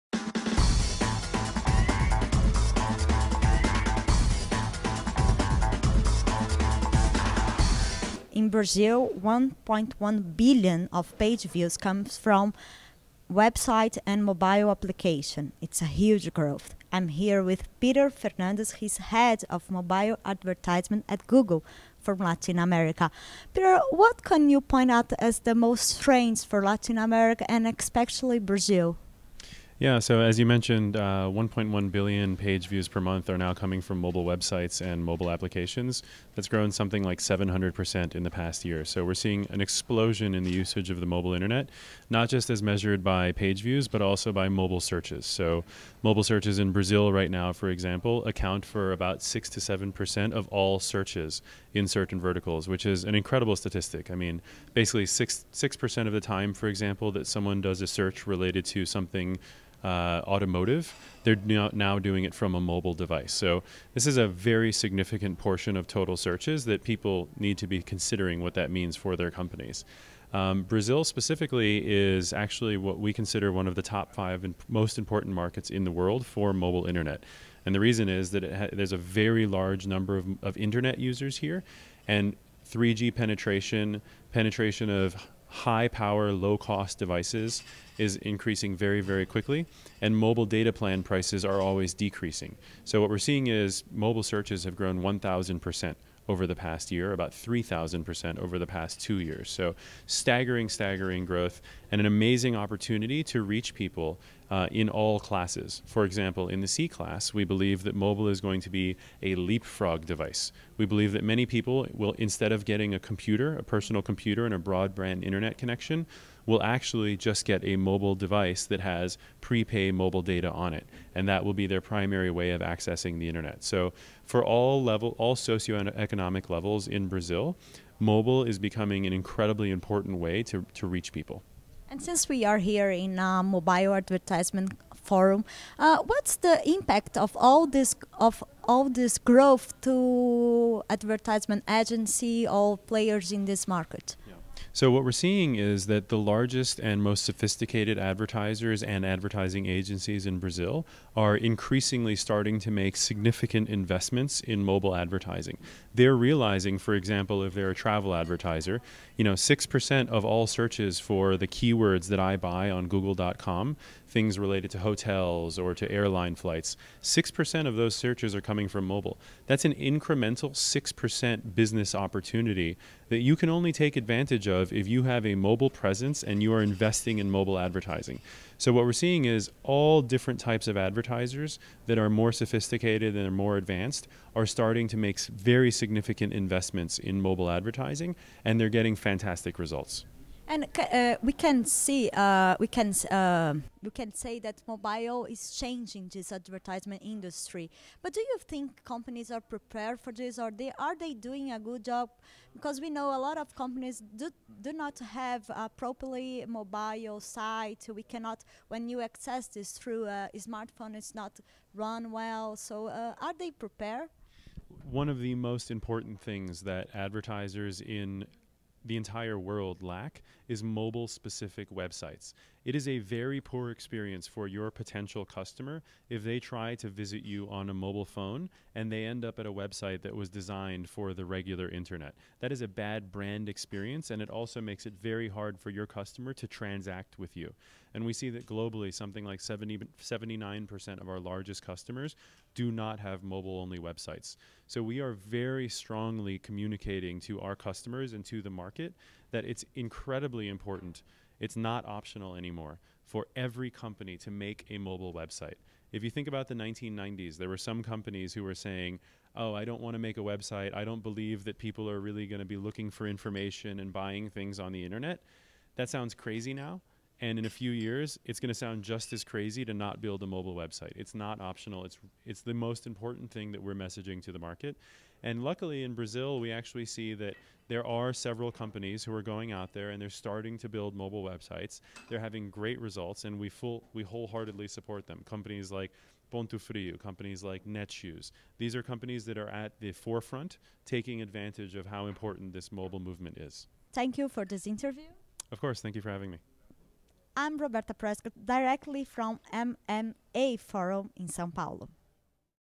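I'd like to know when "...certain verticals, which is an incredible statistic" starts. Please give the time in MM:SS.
00:51.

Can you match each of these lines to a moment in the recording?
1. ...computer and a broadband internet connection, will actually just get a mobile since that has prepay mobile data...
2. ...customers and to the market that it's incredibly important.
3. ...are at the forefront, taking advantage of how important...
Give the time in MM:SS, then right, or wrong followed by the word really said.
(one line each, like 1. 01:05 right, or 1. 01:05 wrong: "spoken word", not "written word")
1. 01:54 wrong: "device", not "since"
2. 04:07 right
3. 04:49 right.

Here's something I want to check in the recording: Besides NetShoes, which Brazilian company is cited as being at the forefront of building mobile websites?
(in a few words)
Ponto Frio.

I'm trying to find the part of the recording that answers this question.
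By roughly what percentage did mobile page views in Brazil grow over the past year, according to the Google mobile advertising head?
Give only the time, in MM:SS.
00:37.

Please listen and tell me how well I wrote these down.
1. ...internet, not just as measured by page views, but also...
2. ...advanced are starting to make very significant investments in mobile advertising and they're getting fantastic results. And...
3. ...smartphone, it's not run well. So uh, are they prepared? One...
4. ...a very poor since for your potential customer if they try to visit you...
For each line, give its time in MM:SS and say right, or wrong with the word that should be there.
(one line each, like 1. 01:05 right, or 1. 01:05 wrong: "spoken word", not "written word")
1. 00:41 right
2. 03:03 right
3. 03:30 right
4. 03:42 wrong: "experience", not "since".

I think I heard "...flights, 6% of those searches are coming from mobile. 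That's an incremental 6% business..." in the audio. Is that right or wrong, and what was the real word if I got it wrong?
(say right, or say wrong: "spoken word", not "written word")
right.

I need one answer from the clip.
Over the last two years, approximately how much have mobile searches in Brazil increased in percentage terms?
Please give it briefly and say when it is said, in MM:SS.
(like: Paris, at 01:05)
3,000%, at 01:37.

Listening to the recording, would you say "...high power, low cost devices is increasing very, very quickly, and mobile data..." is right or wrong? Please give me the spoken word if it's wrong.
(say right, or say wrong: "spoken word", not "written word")
right.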